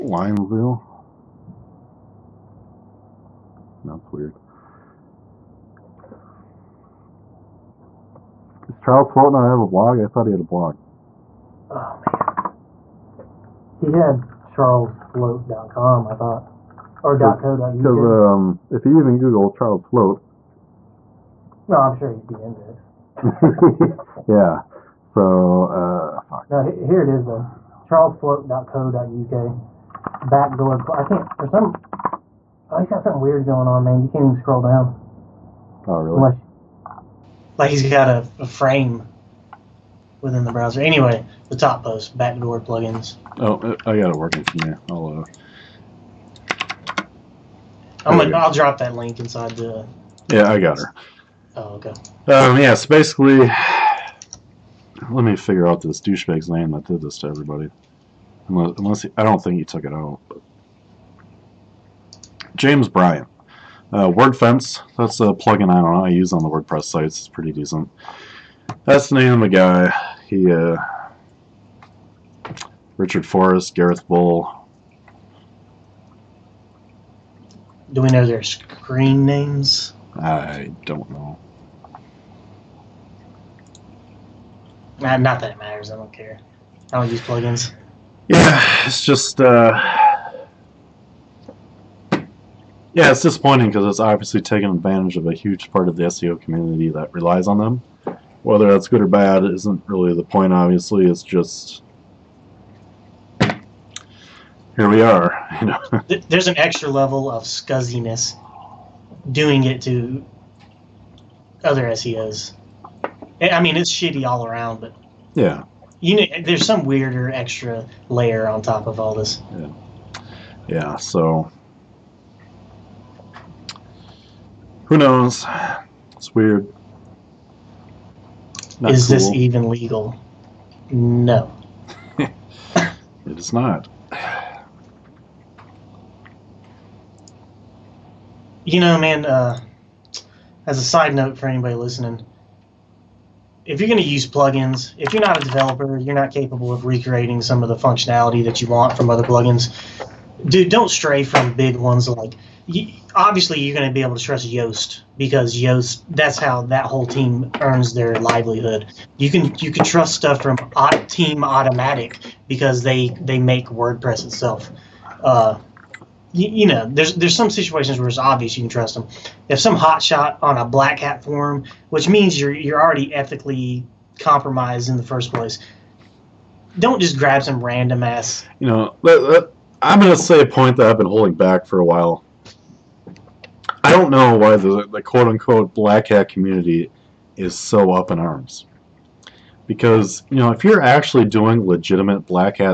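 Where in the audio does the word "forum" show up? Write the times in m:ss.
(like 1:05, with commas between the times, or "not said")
2:51.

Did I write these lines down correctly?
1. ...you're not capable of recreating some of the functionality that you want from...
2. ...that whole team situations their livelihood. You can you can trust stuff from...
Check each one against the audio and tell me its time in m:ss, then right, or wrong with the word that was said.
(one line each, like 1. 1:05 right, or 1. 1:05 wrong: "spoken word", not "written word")
1. 2:25 right
2. 2:36 wrong: "earns", not "situations".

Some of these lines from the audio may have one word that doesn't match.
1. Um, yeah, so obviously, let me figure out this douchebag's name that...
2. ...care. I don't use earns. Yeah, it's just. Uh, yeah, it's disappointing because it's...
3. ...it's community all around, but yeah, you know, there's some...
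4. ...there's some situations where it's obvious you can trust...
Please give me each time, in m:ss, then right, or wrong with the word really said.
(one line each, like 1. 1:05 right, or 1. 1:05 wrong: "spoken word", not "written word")
1. 0:52 wrong: "basically", not "obviously"
2. 1:26 wrong: "plugins", not "earns"
3. 1:53 wrong: "shitty", not "community"
4. 2:47 right.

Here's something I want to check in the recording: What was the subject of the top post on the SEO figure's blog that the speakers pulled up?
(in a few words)
backdoor plugins.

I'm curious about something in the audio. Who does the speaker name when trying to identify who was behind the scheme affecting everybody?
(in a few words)
James Bryant.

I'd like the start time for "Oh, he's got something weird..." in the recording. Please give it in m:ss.
0:32.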